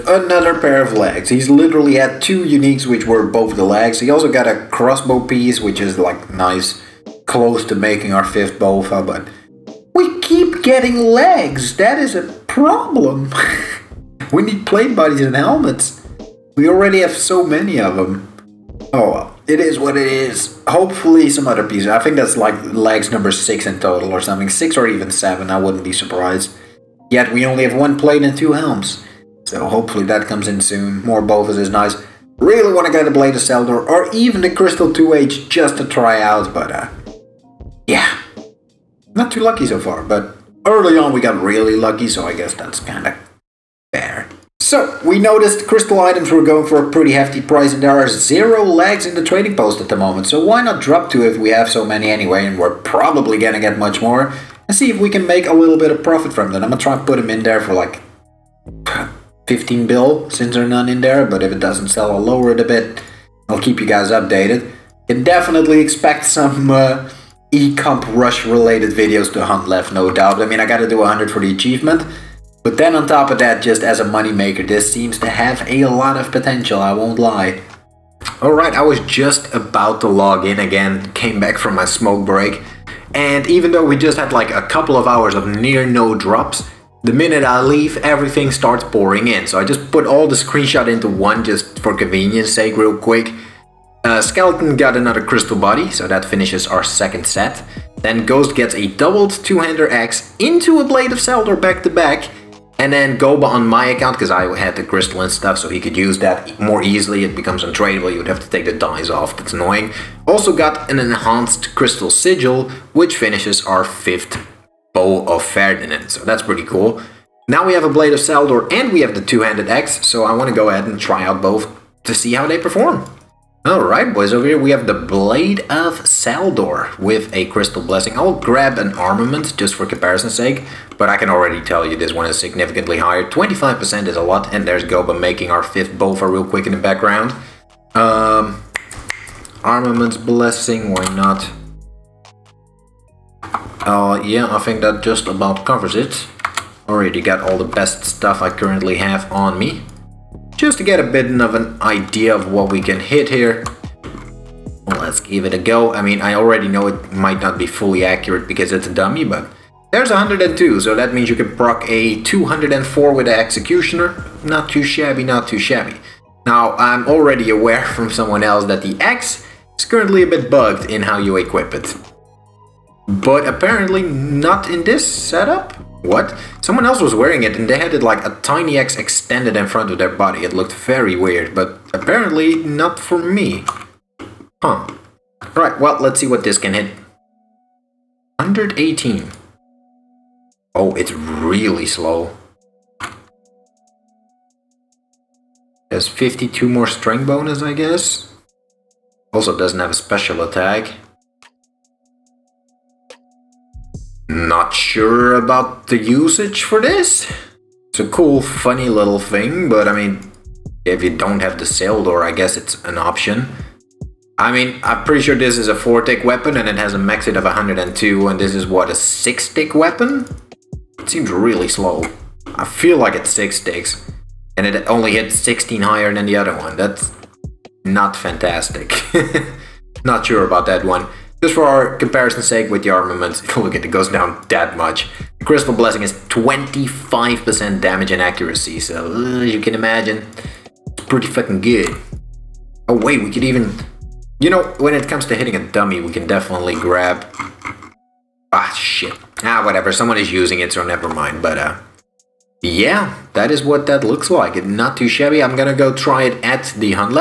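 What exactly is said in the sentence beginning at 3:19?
Also doesn't have a special attack.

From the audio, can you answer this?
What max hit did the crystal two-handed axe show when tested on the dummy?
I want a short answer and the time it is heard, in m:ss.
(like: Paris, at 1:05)
118, at 3:08.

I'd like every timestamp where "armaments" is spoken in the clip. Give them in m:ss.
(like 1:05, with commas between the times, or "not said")
2:08, 2:19, 3:52.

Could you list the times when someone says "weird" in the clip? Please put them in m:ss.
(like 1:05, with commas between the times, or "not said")
3:01.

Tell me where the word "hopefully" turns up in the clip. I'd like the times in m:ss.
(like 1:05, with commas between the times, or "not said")
0:20, 0:29.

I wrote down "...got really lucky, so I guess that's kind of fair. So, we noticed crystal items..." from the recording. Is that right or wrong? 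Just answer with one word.
right.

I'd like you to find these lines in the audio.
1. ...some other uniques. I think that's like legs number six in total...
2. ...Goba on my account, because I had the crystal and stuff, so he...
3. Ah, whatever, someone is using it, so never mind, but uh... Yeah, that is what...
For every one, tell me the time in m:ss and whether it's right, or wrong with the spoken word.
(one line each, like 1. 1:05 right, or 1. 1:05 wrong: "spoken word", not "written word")
1. 0:21 wrong: "pieces", not "uniques"
2. 1:43 right
3. 4:09 right.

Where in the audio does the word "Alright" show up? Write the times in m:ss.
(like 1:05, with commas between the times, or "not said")
1:18, 2:03.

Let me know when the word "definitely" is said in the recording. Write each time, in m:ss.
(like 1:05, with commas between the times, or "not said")
1:05, 4:06.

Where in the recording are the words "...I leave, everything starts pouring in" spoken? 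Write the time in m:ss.
1:27.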